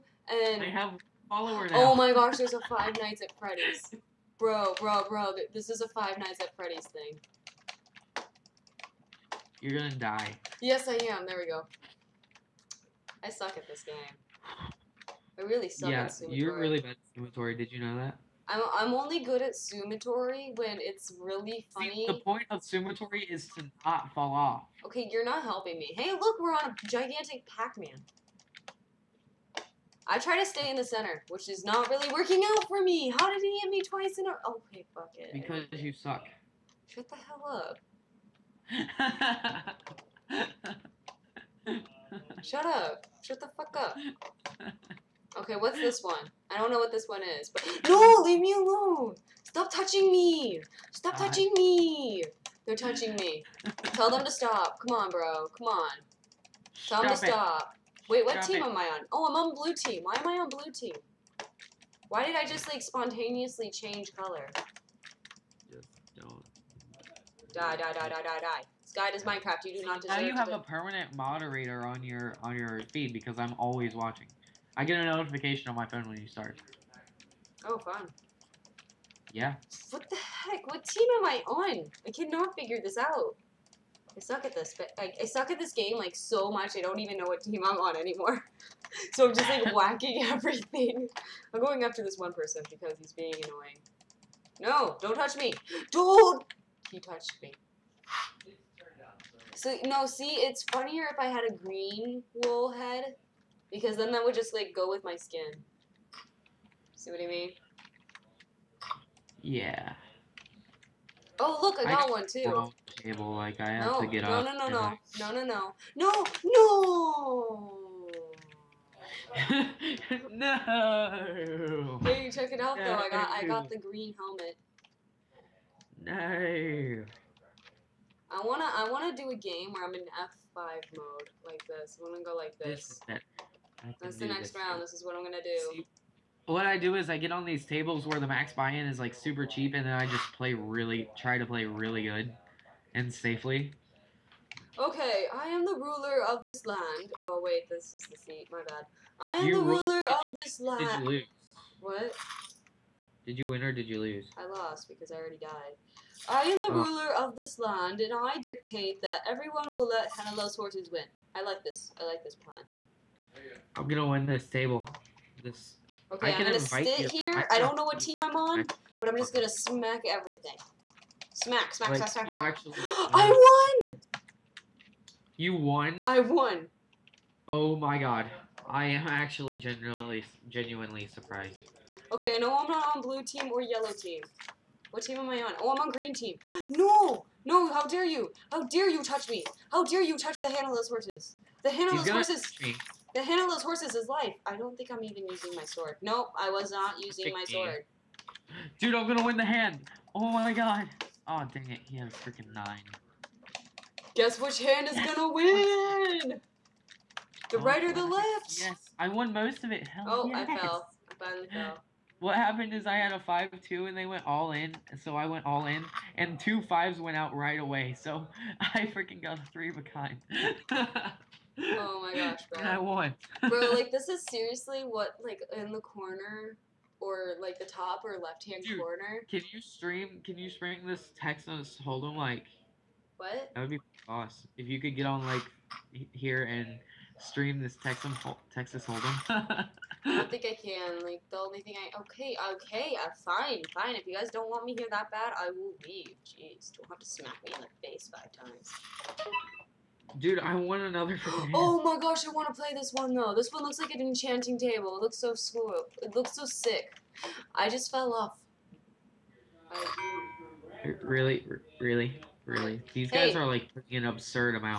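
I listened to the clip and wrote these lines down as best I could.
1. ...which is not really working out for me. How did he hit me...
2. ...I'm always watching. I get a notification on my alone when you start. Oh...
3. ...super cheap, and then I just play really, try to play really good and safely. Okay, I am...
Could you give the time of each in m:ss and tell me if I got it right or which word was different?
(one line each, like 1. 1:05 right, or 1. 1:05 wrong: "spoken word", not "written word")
1. 0:31 right
2. 1:13 wrong: "phone", not "alone"
3. 2:19 right.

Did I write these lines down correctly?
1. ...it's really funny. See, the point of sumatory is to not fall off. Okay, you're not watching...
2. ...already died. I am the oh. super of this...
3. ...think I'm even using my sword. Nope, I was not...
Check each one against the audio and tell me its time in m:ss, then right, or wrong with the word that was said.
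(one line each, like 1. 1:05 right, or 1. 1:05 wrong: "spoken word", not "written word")
1. 0:20 wrong: "helping", not "watching"
2. 2:35 wrong: "ruler", not "super"
3. 3:14 right.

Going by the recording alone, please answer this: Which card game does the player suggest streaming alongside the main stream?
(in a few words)
Texas Hold'em.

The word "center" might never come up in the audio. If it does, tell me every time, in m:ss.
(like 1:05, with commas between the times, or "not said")
0:30.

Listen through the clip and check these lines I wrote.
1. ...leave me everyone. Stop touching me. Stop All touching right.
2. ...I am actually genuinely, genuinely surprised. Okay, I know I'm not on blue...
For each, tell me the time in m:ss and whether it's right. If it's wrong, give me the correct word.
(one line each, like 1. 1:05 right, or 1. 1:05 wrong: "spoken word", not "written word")
1. 0:48 wrong: "alone", not "everyone"
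2. 2:58 right.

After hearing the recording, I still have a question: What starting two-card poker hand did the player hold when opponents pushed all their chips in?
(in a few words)
5-2.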